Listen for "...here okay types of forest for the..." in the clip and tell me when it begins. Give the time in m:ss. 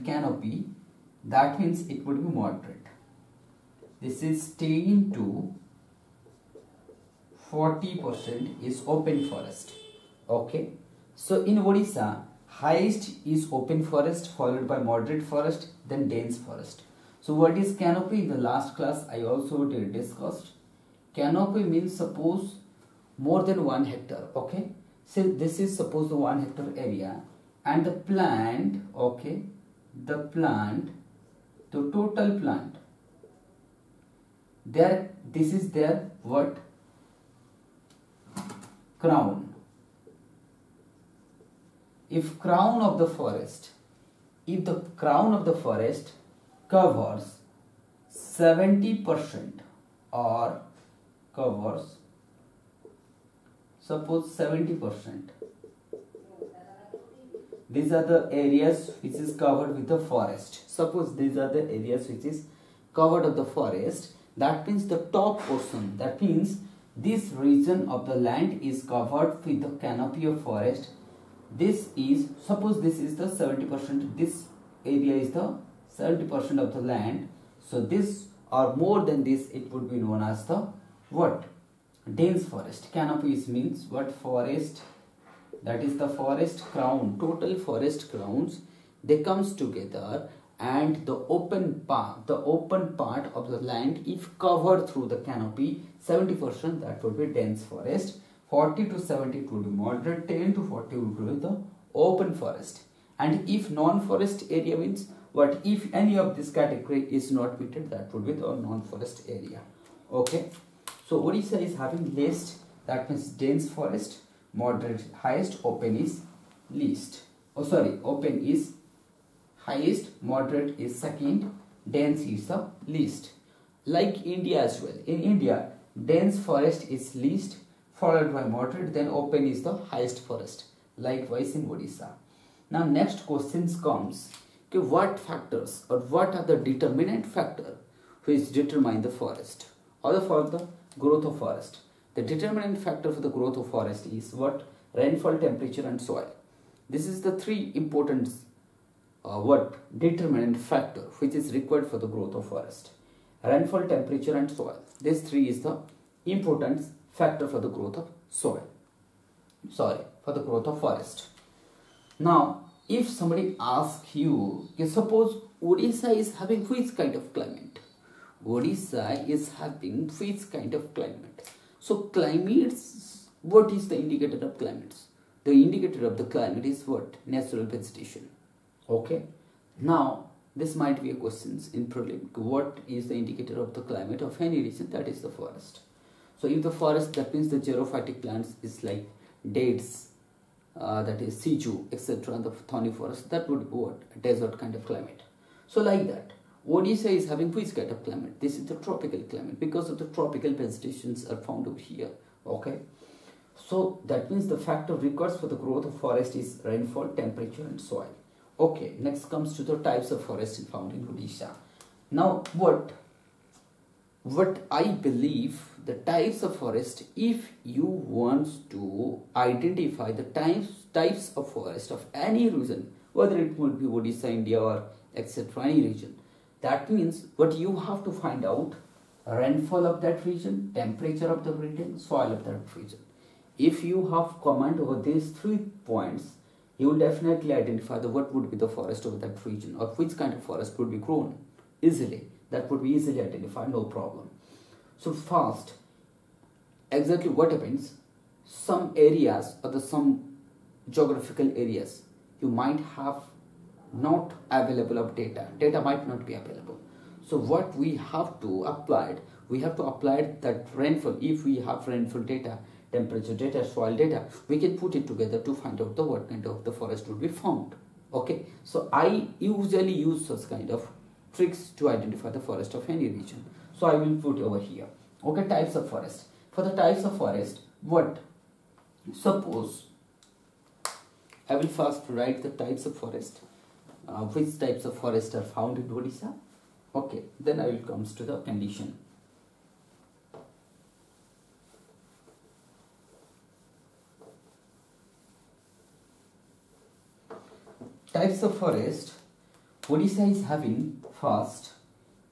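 4:34.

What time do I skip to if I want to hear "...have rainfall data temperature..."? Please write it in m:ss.
4:21.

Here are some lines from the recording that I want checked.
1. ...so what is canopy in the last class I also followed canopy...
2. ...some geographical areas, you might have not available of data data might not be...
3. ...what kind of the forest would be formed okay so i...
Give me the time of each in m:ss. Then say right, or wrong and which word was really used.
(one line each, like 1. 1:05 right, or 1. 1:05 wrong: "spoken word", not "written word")
1. 0:17 wrong: "discussed", not "followed"
2. 4:09 right
3. 4:26 right.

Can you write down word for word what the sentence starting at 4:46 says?
Okay, then I will comes to the condition.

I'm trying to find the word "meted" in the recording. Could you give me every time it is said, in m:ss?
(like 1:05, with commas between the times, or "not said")
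1:47.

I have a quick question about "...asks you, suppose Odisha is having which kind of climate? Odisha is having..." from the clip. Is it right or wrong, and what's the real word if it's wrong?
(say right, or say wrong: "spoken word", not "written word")
right.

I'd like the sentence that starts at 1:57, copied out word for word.
Oh sorry, open is highest, moderate is second, dense is the least.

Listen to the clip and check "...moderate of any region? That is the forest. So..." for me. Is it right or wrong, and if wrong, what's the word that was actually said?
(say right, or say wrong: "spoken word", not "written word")
wrong: "climate", not "moderate".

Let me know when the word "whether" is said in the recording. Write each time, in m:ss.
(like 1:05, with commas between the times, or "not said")
3:43.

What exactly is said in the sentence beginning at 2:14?
Okay, what factors or what are the determinant factor which determine the forest?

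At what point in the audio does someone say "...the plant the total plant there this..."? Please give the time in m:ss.
0:30.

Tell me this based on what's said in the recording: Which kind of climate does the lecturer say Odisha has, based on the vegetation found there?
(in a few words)
Tropical climate.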